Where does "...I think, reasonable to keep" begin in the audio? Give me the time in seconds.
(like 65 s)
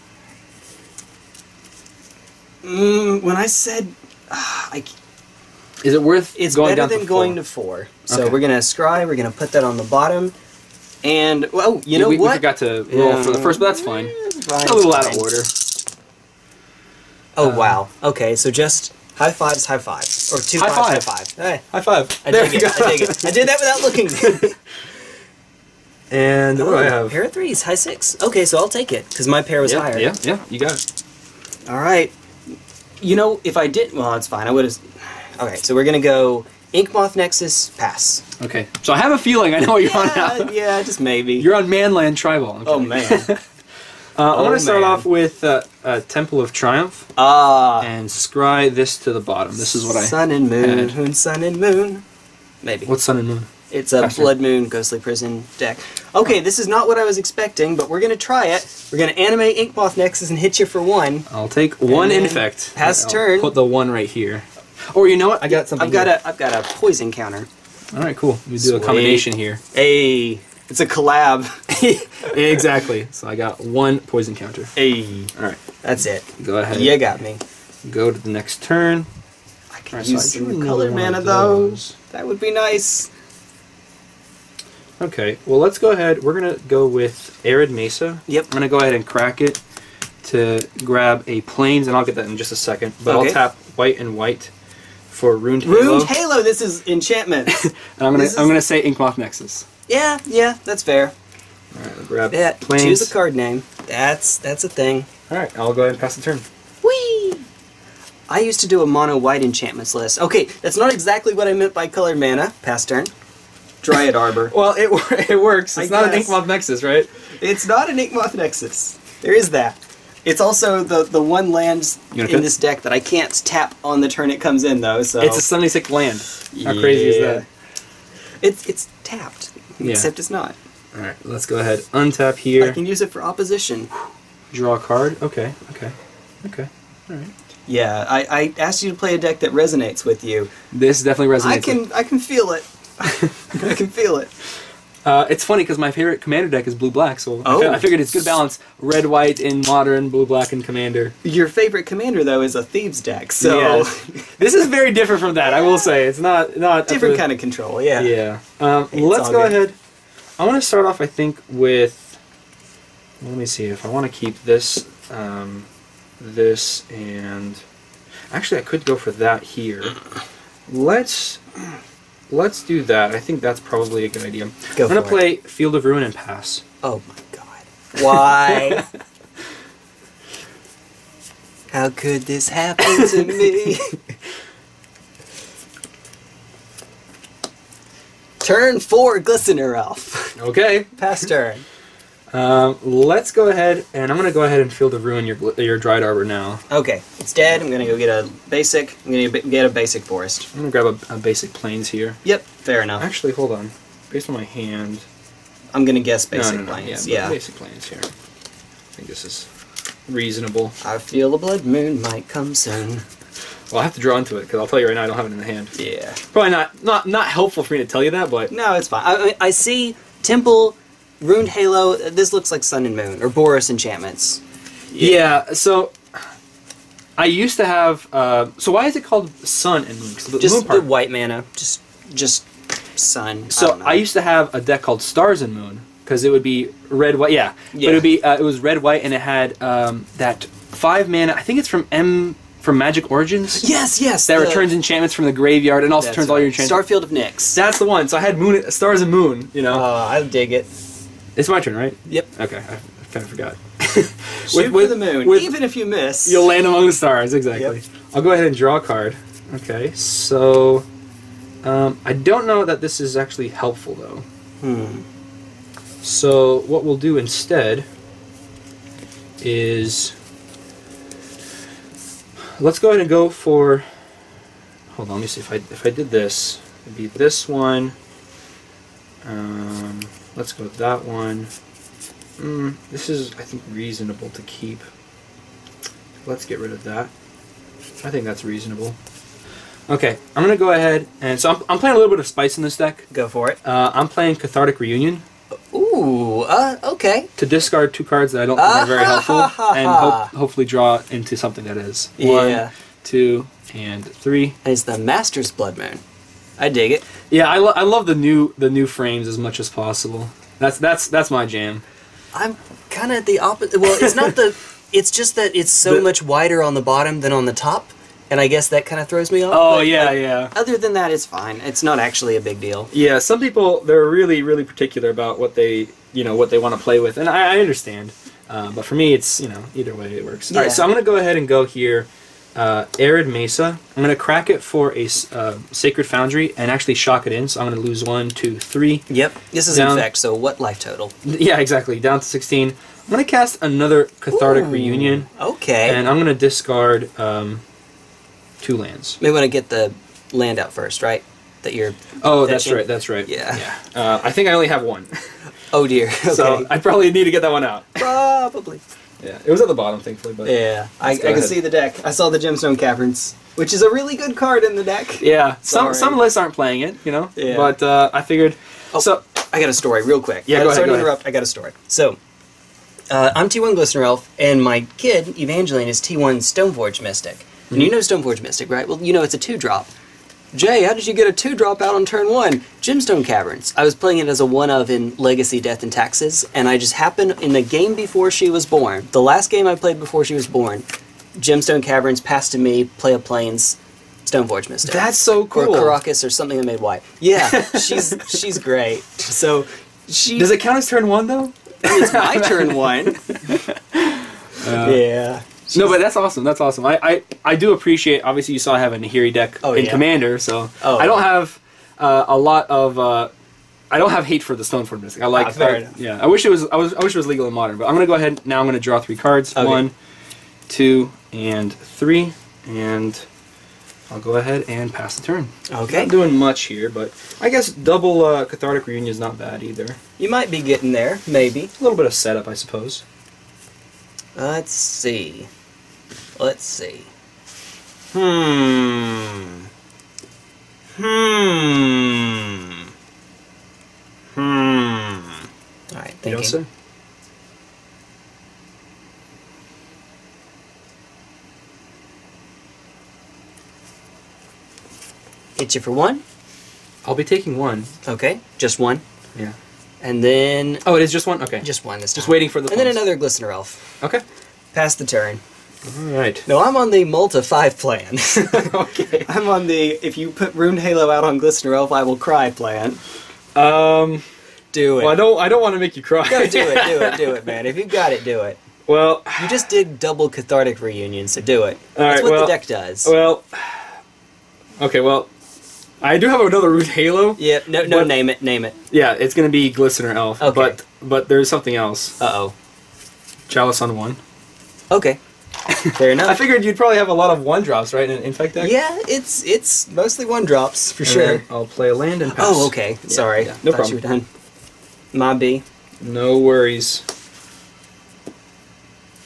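283 s.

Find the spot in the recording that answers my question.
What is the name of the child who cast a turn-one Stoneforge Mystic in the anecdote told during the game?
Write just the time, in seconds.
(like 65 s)
375 s.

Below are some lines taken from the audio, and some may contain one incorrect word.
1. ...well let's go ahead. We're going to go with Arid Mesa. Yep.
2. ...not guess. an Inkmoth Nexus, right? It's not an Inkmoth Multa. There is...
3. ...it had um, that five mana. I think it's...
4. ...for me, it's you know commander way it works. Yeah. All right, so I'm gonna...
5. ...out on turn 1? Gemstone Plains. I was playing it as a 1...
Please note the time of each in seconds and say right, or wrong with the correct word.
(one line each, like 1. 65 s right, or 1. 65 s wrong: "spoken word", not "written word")
1. 85 s right
2. 116 s wrong: "Nexus", not "Multa"
3. 239 s right
4. 328 s wrong: "either", not "commander"
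5. 381 s wrong: "Caverns", not "Plains".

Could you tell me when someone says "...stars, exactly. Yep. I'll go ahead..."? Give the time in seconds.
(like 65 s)
256 s.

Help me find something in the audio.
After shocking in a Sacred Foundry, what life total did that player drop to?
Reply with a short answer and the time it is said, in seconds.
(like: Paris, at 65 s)
16, at 342 s.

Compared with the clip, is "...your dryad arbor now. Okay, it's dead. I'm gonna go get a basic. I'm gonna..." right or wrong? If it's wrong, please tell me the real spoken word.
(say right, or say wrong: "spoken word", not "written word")
right.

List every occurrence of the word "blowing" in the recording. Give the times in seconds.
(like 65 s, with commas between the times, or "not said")
not said.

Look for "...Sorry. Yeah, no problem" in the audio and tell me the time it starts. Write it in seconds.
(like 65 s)
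503 s.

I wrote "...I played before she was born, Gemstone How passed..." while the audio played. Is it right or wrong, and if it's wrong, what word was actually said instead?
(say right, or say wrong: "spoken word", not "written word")
wrong: "Caverns", not "How".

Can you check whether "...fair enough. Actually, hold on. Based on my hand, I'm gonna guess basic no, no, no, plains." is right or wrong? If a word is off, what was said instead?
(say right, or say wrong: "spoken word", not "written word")
right.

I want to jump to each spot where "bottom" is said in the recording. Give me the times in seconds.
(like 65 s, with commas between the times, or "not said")
9 s, 49 s, 316 s, 359 s.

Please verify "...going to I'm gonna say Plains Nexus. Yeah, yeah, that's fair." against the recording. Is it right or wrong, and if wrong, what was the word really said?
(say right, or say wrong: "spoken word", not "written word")
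wrong: "Inkmoth", not "Plains".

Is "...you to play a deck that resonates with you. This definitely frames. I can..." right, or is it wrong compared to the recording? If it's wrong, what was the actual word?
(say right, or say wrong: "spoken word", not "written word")
wrong: "resonates", not "frames".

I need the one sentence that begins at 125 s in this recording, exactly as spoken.
So it's a seventy six land.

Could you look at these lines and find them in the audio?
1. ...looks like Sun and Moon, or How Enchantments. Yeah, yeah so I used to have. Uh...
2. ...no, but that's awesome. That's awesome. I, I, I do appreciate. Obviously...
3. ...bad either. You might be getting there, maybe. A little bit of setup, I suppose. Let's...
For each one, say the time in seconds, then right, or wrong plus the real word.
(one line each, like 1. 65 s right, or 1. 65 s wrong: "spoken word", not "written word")
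1. 222 s wrong: "Boros", not "How"
2. 405 s right
3. 429 s right.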